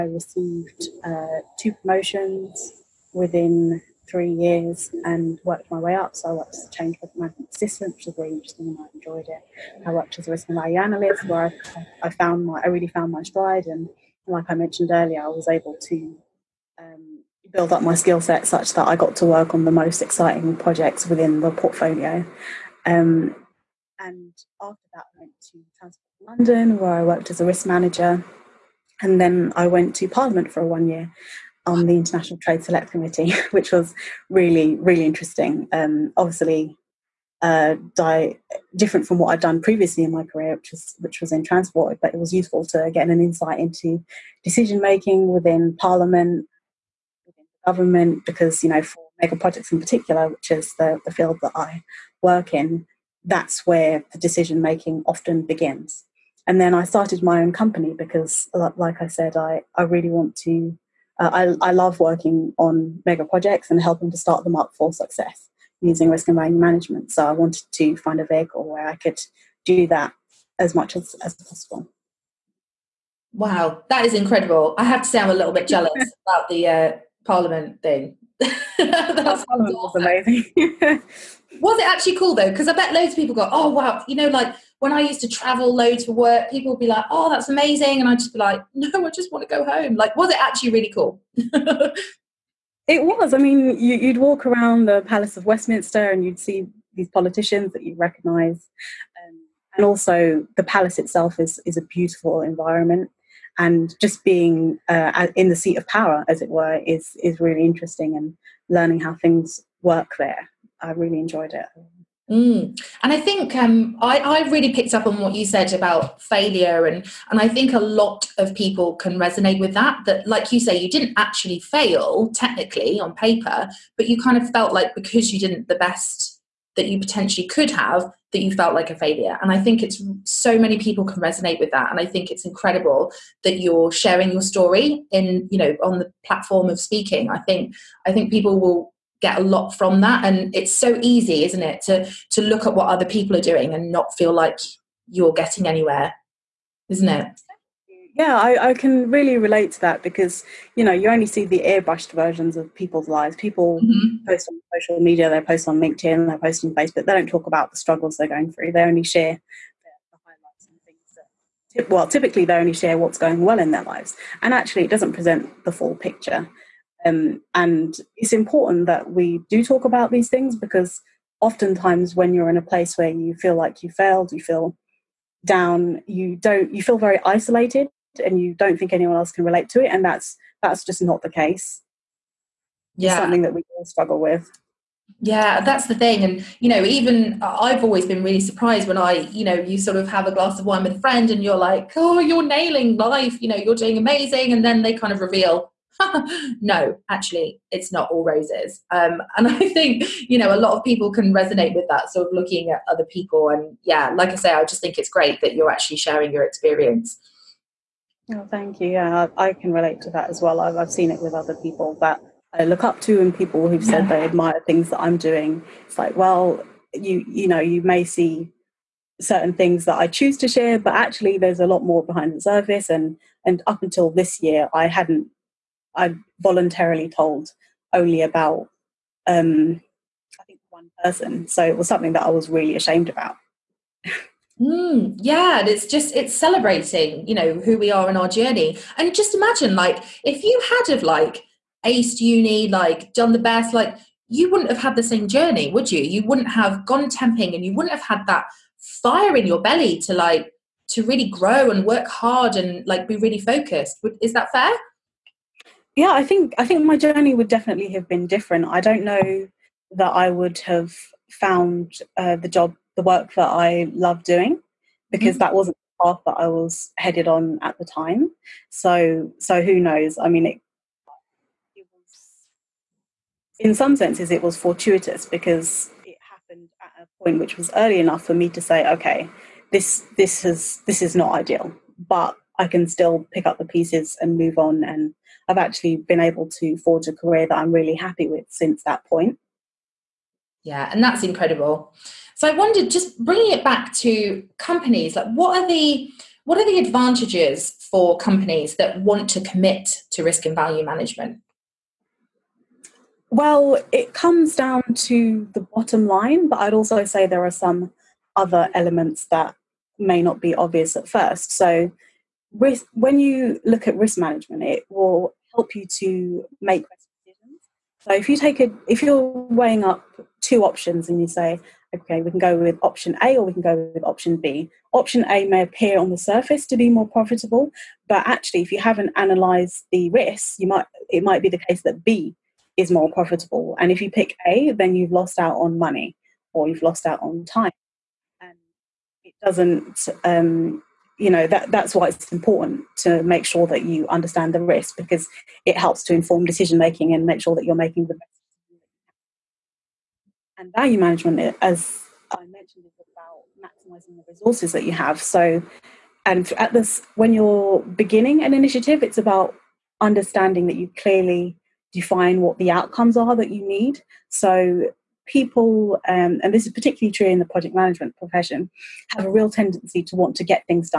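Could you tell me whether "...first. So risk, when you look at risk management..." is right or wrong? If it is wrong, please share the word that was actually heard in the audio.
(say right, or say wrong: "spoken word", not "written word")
right.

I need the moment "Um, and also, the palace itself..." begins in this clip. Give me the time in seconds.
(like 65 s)
99 s.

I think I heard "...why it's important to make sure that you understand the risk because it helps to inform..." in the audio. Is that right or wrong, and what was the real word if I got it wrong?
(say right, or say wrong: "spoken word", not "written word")
right.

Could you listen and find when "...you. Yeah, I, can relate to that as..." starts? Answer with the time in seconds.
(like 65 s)
208 s.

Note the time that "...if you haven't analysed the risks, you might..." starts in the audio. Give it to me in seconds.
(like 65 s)
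328 s.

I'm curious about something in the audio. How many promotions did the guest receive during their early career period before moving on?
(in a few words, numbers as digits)
2.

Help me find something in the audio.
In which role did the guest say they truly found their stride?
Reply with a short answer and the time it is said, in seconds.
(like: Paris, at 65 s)
Risk and value analyst, at 10 s.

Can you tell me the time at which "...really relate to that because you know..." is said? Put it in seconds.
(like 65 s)
149 s.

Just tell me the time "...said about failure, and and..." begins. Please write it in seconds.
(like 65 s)
115 s.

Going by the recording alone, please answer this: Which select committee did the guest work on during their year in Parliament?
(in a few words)
International Trade Select Committee.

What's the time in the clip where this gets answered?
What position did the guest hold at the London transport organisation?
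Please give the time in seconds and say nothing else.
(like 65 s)
27 s.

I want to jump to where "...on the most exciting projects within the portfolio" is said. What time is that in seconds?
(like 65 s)
19 s.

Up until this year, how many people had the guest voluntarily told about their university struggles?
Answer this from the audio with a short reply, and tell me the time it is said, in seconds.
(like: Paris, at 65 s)
1, at 230 s.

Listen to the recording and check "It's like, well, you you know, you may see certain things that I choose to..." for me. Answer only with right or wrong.
right.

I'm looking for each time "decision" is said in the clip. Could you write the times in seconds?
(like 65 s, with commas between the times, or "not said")
44 s, 54 s, 316 s, 346 s.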